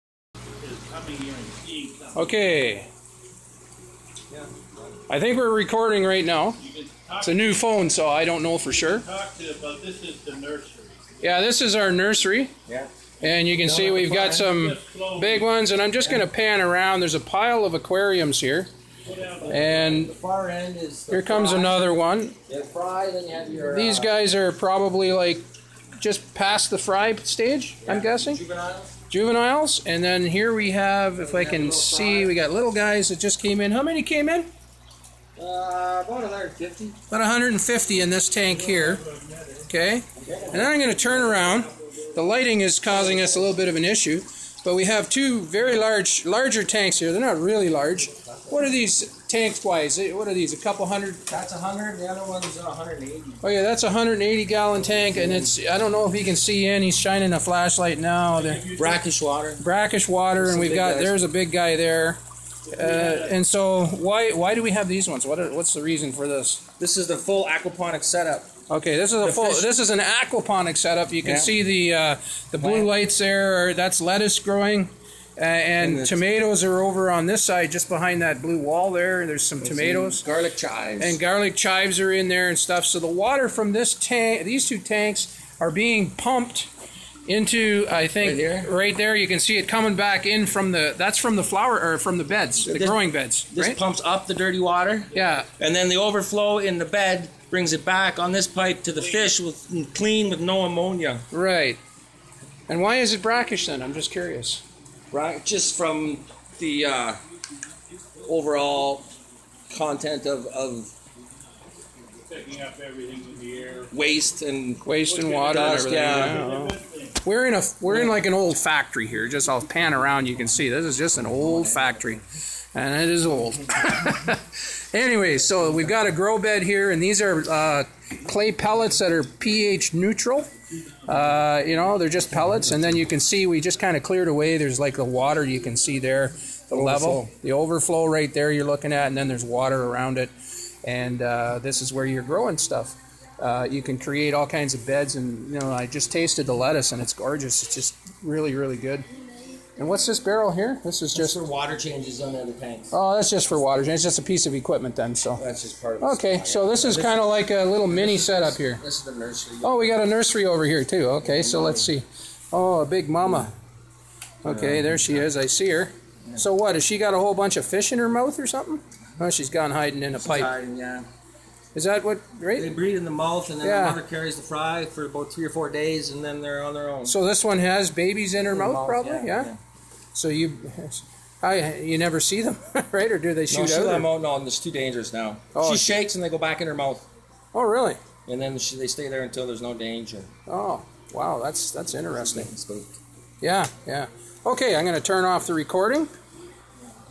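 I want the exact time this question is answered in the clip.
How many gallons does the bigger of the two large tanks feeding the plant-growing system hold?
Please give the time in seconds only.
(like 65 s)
53 s.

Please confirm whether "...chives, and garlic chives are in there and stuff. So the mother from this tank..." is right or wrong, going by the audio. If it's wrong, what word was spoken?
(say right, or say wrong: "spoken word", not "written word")
wrong: "water", not "mother".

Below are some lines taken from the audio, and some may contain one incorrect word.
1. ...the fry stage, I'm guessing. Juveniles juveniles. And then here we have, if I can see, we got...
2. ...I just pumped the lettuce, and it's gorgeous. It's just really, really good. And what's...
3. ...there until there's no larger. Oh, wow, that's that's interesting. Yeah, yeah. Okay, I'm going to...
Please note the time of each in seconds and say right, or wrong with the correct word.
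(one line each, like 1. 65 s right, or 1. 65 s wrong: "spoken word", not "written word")
1. 26 s right
2. 145 s wrong: "tasted", not "pumped"
3. 189 s wrong: "danger", not "larger".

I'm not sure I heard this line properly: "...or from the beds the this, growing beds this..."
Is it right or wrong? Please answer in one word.
right.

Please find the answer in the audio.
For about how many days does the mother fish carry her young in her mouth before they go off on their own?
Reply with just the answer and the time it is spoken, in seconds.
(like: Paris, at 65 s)
3 or 4 days, at 175 s.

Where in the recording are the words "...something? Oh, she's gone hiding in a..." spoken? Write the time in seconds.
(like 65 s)
168 s.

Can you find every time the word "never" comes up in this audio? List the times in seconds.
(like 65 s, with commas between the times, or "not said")
181 s.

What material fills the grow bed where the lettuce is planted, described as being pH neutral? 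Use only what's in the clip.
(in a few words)
Clay pellets.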